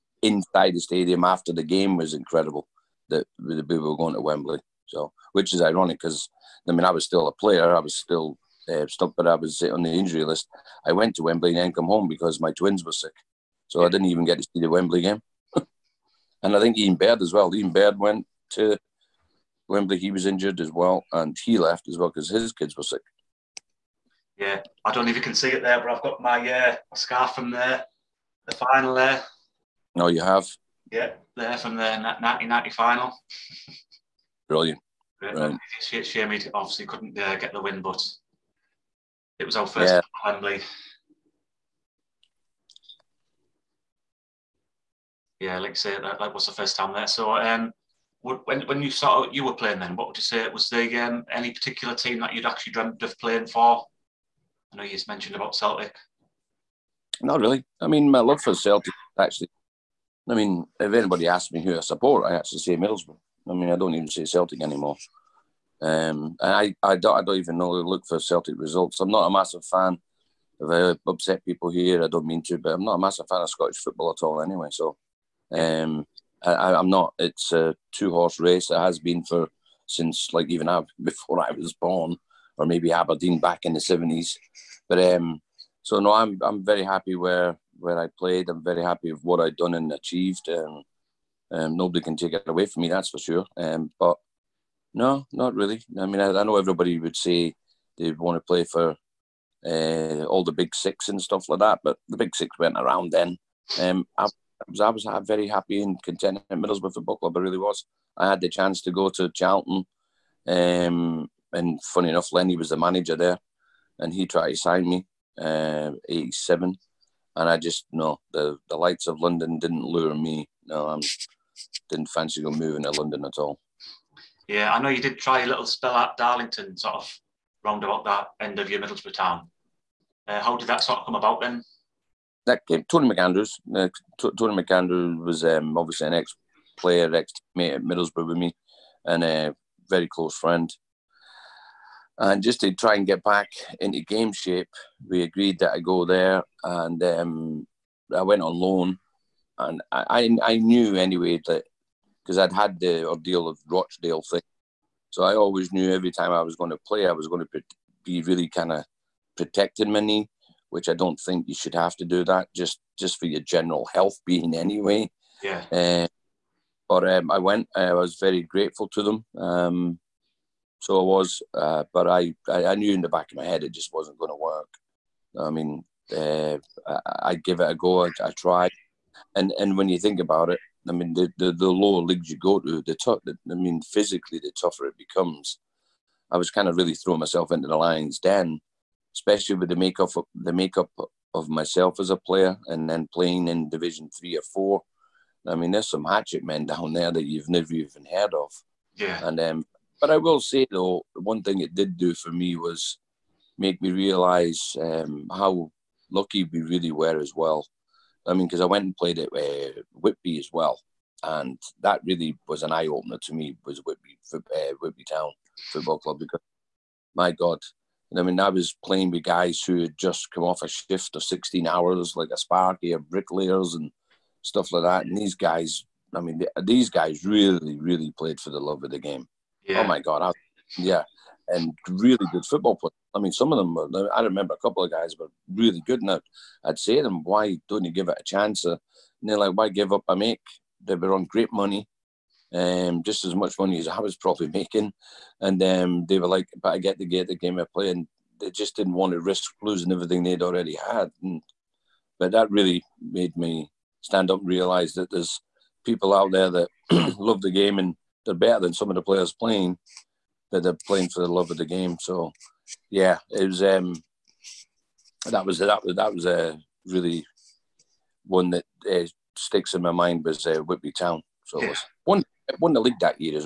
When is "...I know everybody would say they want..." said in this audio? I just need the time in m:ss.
1:36.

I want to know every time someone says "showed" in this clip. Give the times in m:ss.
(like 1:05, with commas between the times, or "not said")
not said.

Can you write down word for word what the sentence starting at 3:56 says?
And I'd, I'd say to them, why don't you give it a chance?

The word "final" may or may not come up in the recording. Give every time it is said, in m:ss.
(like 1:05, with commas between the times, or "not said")
0:28, 0:32.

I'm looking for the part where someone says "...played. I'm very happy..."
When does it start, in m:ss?
1:28.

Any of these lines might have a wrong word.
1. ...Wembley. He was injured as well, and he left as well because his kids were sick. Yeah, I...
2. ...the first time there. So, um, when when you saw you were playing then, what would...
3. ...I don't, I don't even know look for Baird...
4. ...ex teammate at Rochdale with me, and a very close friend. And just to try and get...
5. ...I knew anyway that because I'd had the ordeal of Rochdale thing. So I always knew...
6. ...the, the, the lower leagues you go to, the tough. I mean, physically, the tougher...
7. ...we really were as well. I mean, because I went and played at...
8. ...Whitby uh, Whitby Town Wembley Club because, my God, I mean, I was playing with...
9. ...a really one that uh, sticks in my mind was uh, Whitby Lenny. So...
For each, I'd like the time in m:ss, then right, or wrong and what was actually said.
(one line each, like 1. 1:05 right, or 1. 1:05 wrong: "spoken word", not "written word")
1. 0:19 right
2. 0:46 right
3. 1:06 wrong: "Celtic", not "Baird"
4. 2:17 wrong: "Middlesbrough", not "Rochdale"
5. 2:30 right
6. 3:01 right
7. 3:26 right
8. 3:33 wrong: "Football", not "Wembley"
9. 4:26 wrong: "Town", not "Lenny".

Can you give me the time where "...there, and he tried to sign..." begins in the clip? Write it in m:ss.
1:53.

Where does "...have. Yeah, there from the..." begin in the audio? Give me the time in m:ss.
0:30.